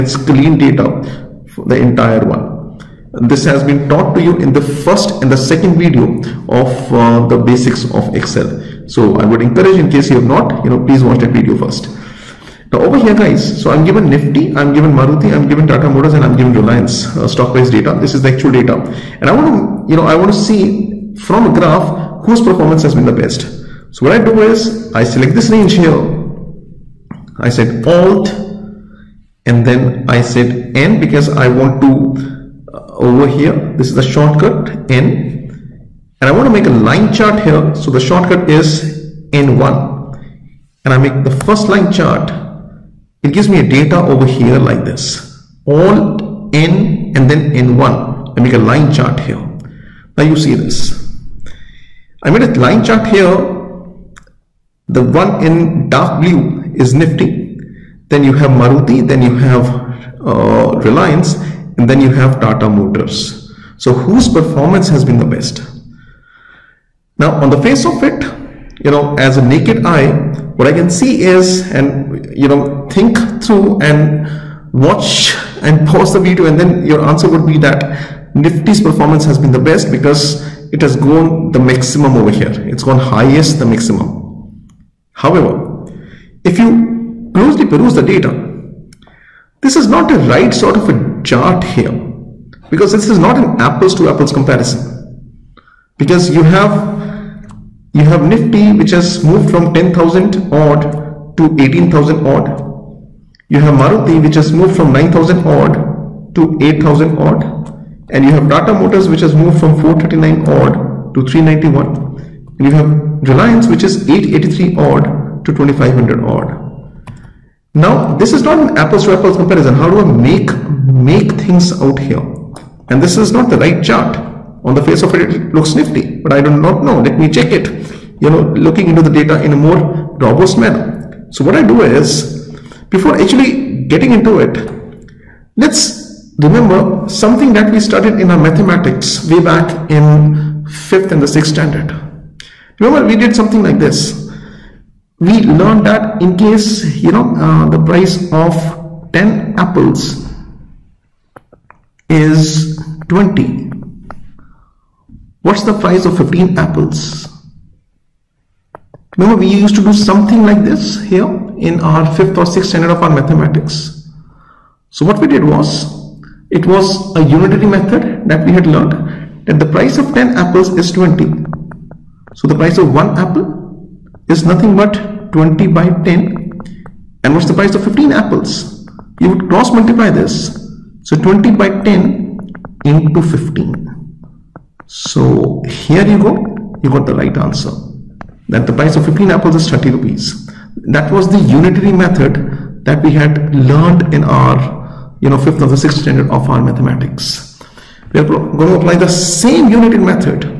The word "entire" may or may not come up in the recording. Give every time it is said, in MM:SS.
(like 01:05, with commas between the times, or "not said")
00:01.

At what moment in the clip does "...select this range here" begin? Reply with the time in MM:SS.
00:25.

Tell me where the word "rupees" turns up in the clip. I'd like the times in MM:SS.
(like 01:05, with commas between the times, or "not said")
03:09.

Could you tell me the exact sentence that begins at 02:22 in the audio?
Remember, we did something like this.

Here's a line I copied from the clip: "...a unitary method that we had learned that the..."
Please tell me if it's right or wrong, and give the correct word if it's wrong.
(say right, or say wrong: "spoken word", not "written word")
right.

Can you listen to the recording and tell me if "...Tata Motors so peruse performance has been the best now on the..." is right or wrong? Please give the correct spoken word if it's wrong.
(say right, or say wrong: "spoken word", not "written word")
wrong: "whose", not "peruse".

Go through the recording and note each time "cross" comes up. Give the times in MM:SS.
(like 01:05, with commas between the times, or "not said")
02:59.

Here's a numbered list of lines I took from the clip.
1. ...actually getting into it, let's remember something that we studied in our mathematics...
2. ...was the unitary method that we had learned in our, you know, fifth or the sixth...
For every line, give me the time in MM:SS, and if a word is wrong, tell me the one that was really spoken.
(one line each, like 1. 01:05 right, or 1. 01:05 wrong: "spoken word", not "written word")
1. 02:13 right
2. 03:11 right.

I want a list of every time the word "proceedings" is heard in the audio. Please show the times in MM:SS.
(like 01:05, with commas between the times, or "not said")
not said.